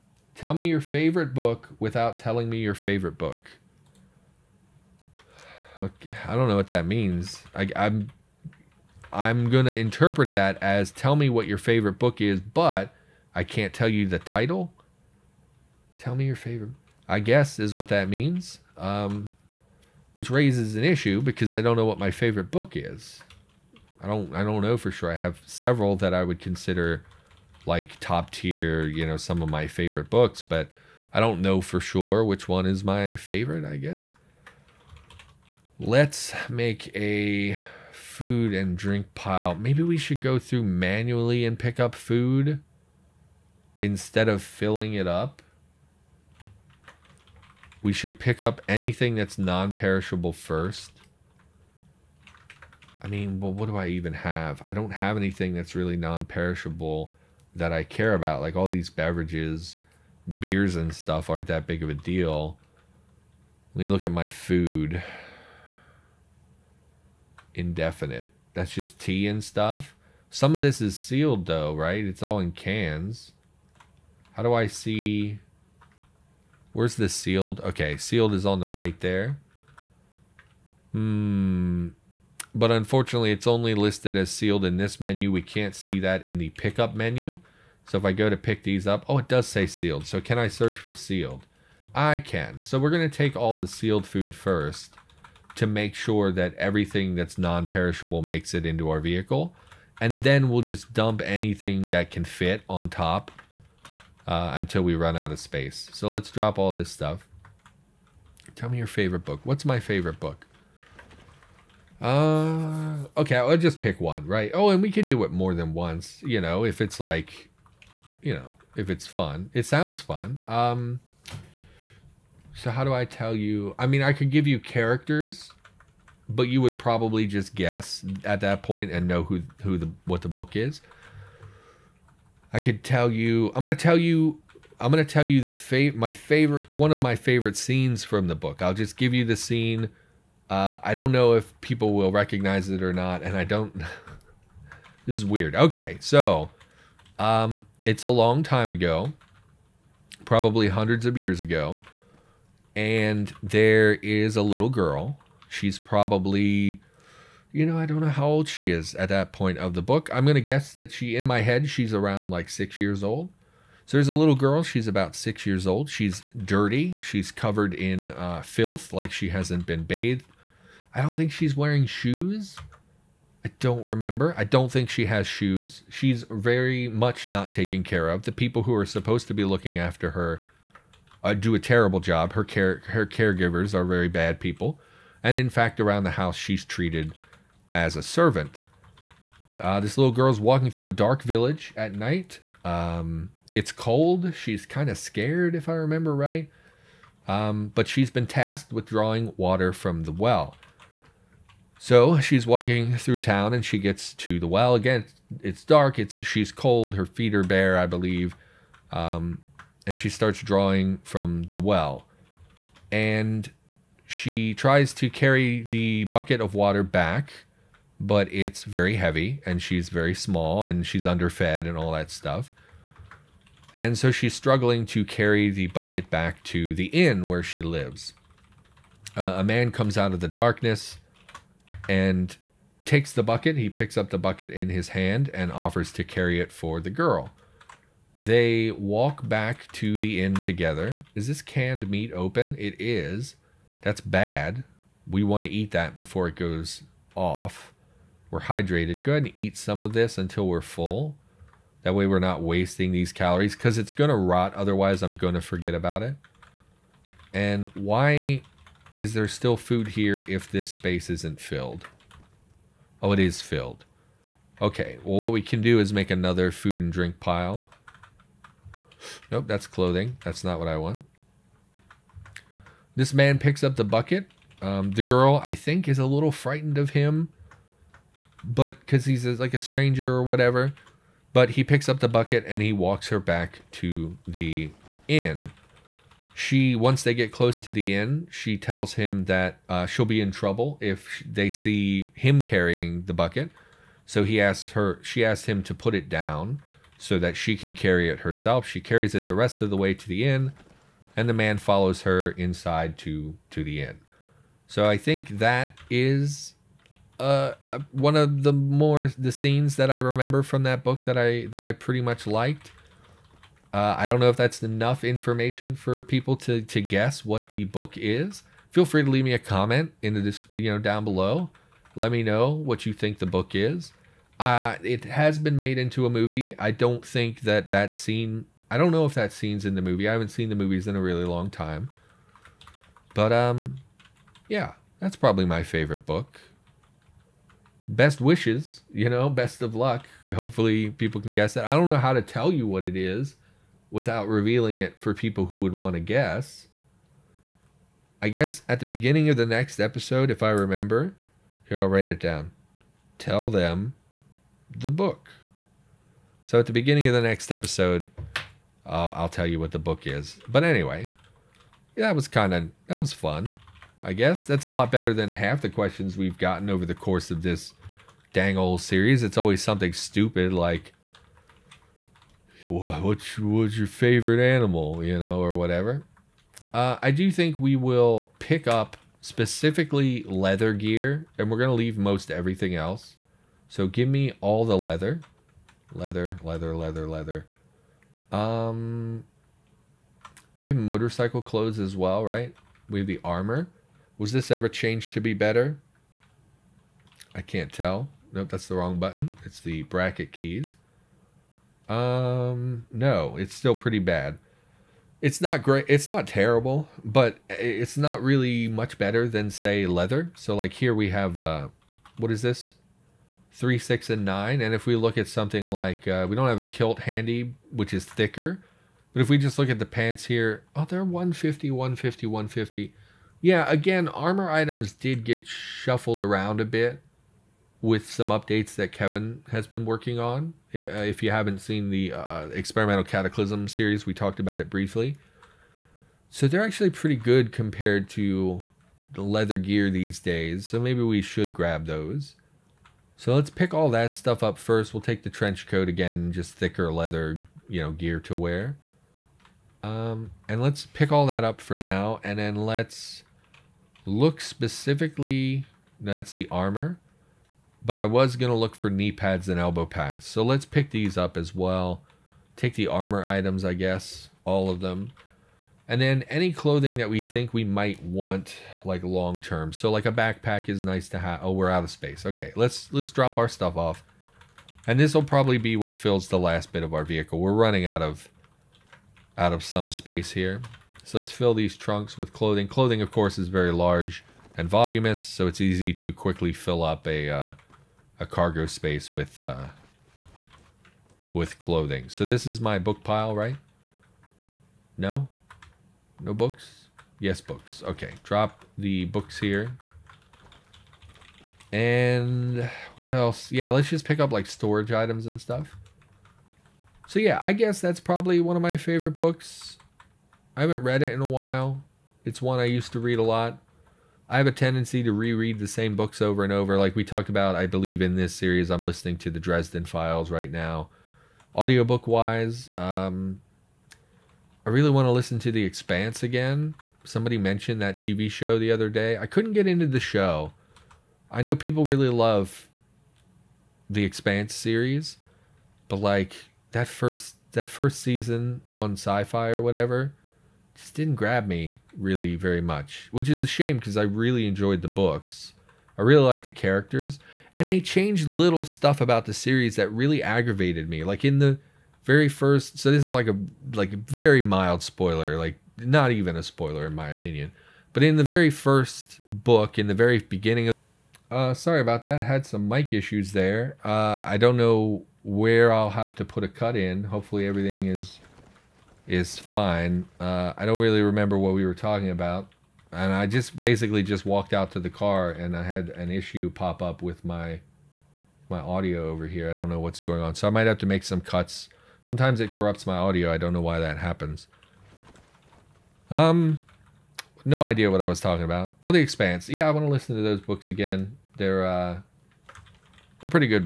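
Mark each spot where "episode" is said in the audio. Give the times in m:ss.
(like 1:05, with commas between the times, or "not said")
5:49, 5:57.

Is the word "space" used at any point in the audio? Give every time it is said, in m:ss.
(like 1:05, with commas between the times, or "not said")
1:45, 4:20, 7:51, 7:59, 8:08.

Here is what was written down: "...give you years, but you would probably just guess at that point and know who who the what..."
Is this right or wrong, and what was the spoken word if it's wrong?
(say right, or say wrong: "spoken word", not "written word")
wrong: "characters", not "years".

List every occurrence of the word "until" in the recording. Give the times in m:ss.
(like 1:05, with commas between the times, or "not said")
1:44, 4:10.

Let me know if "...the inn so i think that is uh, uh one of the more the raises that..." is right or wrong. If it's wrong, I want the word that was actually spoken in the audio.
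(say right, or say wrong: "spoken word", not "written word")
wrong: "scenes", not "raises".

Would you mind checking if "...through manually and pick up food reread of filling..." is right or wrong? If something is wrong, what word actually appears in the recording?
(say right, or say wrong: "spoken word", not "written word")
wrong: "instead", not "reread".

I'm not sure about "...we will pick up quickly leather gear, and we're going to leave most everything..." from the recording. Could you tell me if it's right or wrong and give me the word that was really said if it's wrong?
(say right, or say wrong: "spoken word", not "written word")
wrong: "specifically", not "quickly".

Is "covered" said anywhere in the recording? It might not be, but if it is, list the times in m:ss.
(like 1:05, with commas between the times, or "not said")
2:47.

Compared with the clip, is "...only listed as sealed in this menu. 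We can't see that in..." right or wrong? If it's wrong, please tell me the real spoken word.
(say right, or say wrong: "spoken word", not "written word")
right.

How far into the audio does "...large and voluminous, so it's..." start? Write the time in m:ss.
8:03.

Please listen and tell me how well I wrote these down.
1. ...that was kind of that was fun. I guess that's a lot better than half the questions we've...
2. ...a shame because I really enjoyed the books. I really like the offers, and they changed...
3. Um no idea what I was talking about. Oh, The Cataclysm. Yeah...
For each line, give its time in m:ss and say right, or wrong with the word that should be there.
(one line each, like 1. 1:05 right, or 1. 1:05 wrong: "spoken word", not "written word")
1. 6:02 right
2. 9:03 wrong: "characters", not "offers"
3. 9:46 wrong: "Expanse", not "Cataclysm".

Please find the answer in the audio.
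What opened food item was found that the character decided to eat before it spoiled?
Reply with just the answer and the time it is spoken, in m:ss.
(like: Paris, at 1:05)
Canned meat, at 4:01.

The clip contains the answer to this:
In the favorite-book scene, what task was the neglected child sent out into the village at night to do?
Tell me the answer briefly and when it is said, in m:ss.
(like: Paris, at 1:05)
Drawing water from the well, at 3:18.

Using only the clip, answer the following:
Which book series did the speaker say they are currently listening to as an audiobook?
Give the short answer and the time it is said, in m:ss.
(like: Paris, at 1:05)
The Dresden Files, at 8:39.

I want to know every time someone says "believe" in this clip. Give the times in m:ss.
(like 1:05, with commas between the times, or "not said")
3:27, 8:37.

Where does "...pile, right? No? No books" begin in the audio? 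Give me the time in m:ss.
8:13.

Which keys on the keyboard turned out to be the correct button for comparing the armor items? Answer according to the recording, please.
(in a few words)
Bracket keys.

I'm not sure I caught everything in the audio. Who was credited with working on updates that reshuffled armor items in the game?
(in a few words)
Kevin.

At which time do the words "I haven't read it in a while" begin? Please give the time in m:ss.
8:30.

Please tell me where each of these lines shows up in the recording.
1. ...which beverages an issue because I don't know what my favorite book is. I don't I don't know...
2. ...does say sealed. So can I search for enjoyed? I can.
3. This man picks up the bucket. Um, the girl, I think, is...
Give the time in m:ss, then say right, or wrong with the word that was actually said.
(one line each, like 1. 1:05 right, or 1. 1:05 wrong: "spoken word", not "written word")
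1. 0:20 wrong: "raises", not "beverages"
2. 1:29 wrong: "sealed", not "enjoyed"
3. 4:32 right.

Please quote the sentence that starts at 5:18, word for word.
Feel free to leave me a comment in the you know, down below.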